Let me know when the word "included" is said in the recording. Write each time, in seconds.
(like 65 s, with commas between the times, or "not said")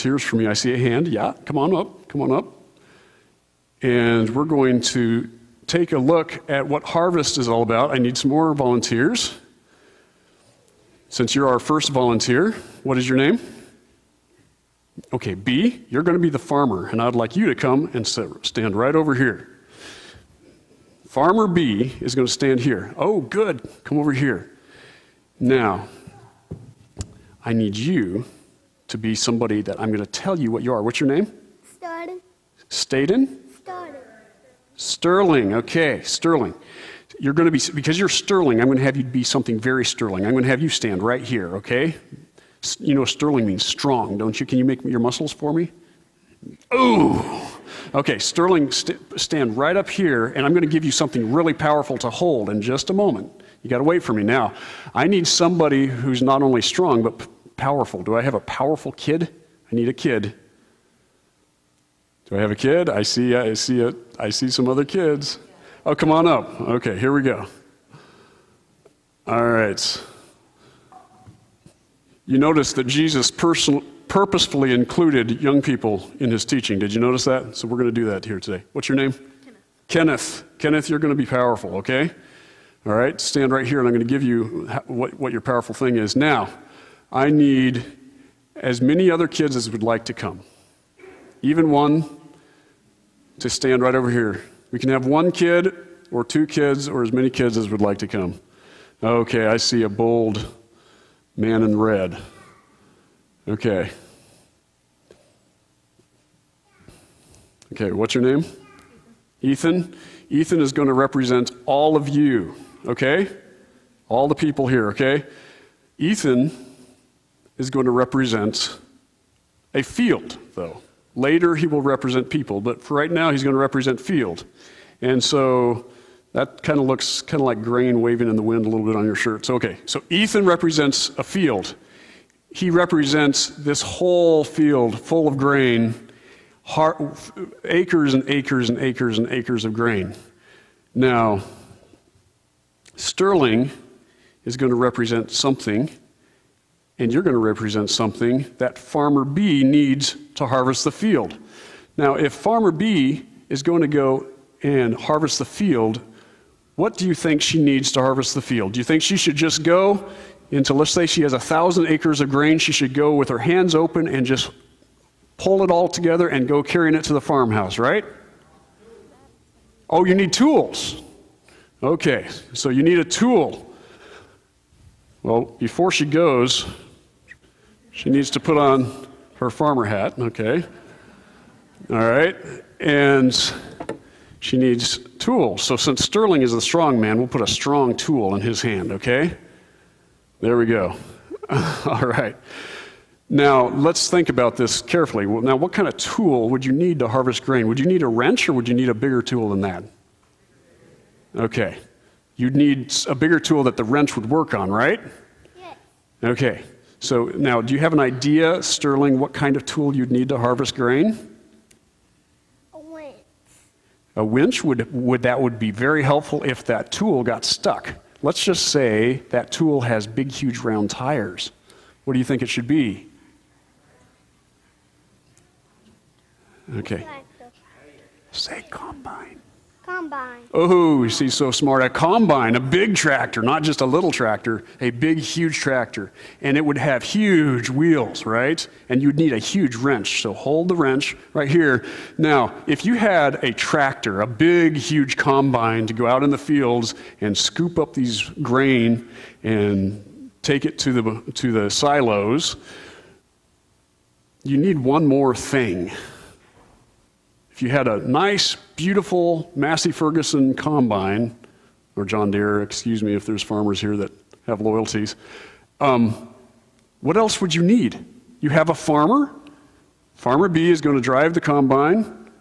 74 s.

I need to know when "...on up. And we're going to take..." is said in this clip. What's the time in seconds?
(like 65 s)
2 s.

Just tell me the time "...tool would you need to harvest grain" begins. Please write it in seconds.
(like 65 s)
195 s.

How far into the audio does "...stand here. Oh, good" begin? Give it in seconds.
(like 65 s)
22 s.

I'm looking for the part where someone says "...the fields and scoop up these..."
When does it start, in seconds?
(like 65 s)
246 s.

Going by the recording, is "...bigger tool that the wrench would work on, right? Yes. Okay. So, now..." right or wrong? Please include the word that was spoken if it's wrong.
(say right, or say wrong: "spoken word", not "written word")
right.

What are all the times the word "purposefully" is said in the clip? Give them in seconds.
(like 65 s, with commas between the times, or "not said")
74 s.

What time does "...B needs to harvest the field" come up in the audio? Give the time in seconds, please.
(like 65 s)
149 s.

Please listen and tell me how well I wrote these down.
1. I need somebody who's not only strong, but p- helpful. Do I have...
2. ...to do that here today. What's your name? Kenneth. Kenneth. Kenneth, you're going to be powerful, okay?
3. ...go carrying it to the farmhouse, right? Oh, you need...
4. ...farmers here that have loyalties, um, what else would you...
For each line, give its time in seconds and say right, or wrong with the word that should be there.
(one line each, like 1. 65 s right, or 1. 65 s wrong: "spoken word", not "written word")
1. 54 s wrong: "powerful", not "helpful"
2. 77 s right
3. 166 s right
4. 263 s right.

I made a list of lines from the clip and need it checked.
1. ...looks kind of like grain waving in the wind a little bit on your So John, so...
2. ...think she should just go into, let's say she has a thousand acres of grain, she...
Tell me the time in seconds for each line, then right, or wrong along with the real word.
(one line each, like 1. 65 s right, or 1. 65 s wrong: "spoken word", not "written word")
1. 126 s wrong: "Okay", not "John"
2. 158 s right.